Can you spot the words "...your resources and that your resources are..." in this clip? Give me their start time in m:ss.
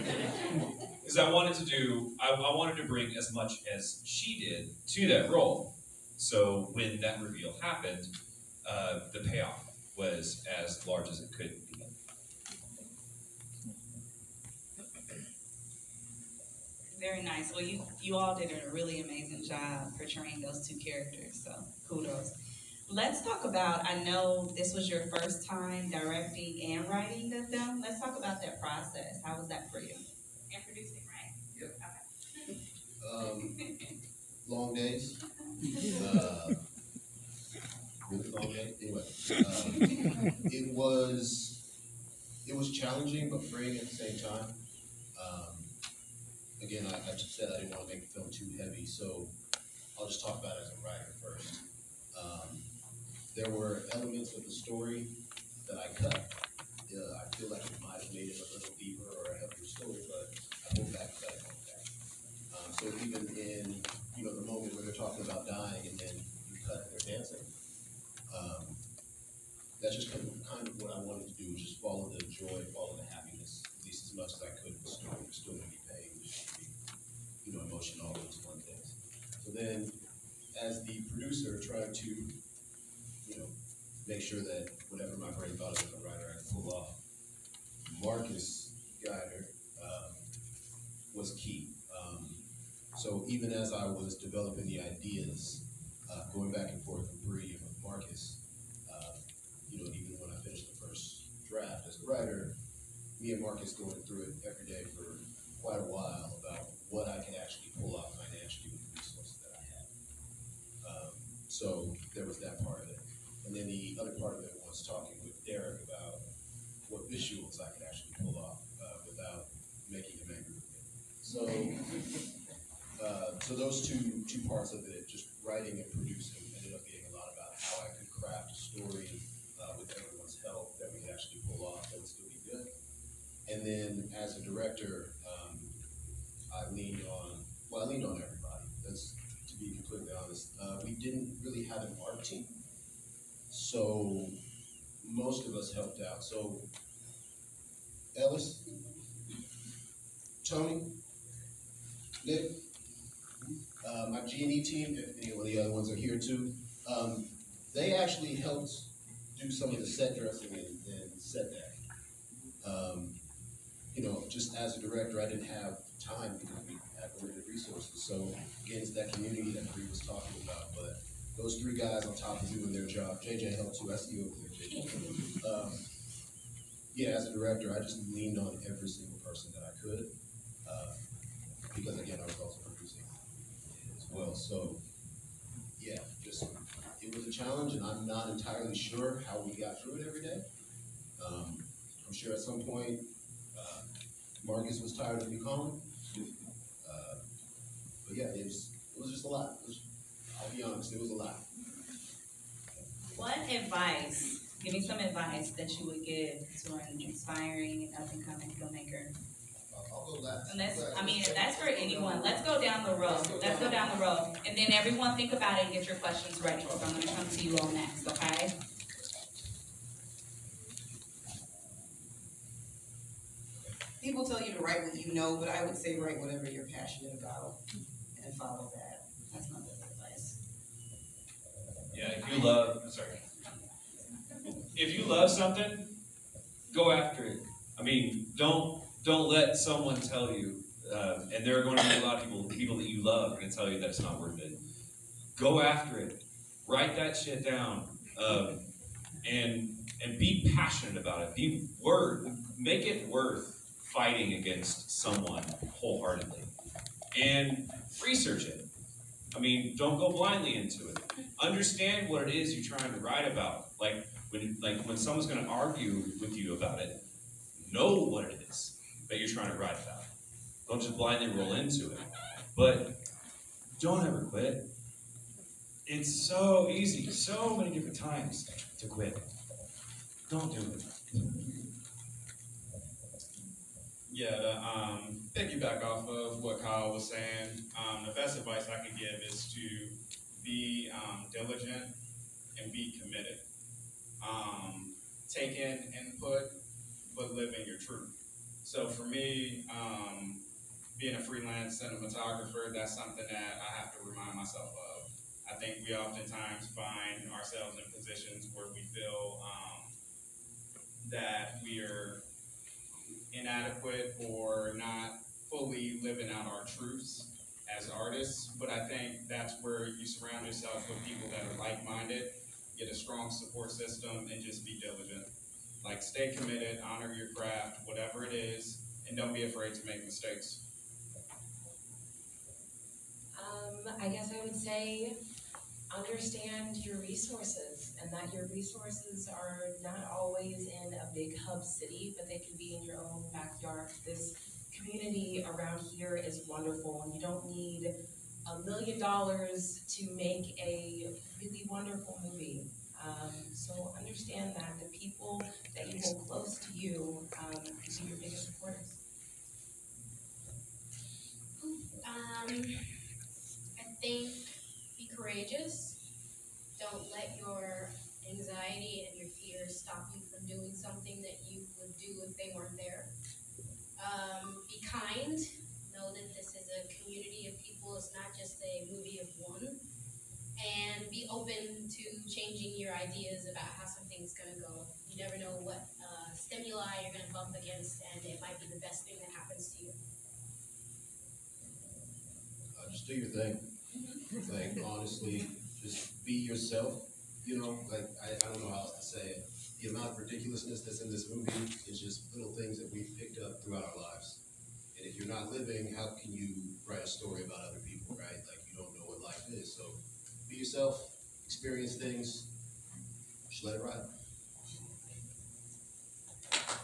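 5:36.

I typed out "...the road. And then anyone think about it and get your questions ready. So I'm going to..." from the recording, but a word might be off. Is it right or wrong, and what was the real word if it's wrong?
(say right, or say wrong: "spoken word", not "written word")
wrong: "everyone", not "anyone".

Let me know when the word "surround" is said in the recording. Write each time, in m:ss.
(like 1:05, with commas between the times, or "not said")
5:20.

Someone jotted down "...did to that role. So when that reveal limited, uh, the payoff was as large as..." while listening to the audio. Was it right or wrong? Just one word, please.
wrong.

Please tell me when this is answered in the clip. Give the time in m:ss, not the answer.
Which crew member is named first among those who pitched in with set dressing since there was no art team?
2:28.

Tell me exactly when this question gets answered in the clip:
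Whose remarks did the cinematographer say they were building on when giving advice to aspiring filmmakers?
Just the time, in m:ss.
4:46.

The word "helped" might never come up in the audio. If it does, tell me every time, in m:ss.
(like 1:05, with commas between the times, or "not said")
2:25, 2:38, 2:53.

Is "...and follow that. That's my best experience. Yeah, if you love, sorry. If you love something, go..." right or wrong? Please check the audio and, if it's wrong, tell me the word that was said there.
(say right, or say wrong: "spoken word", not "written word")
wrong: "advice", not "experience".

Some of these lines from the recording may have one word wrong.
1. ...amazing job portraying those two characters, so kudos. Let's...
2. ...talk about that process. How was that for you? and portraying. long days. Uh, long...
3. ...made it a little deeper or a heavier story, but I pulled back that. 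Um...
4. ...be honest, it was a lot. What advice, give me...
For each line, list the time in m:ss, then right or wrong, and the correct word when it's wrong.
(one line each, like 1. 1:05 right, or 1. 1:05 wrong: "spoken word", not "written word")
1. 0:19 right
2. 0:27 wrong: "producing", not "portraying"
3. 0:58 right
4. 3:20 right.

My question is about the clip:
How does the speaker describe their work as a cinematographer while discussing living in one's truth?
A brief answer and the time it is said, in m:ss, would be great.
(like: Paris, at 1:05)
Freelance, at 5:01.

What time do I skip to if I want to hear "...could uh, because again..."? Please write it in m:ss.
2:59.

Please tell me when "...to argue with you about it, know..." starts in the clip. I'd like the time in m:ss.
4:25.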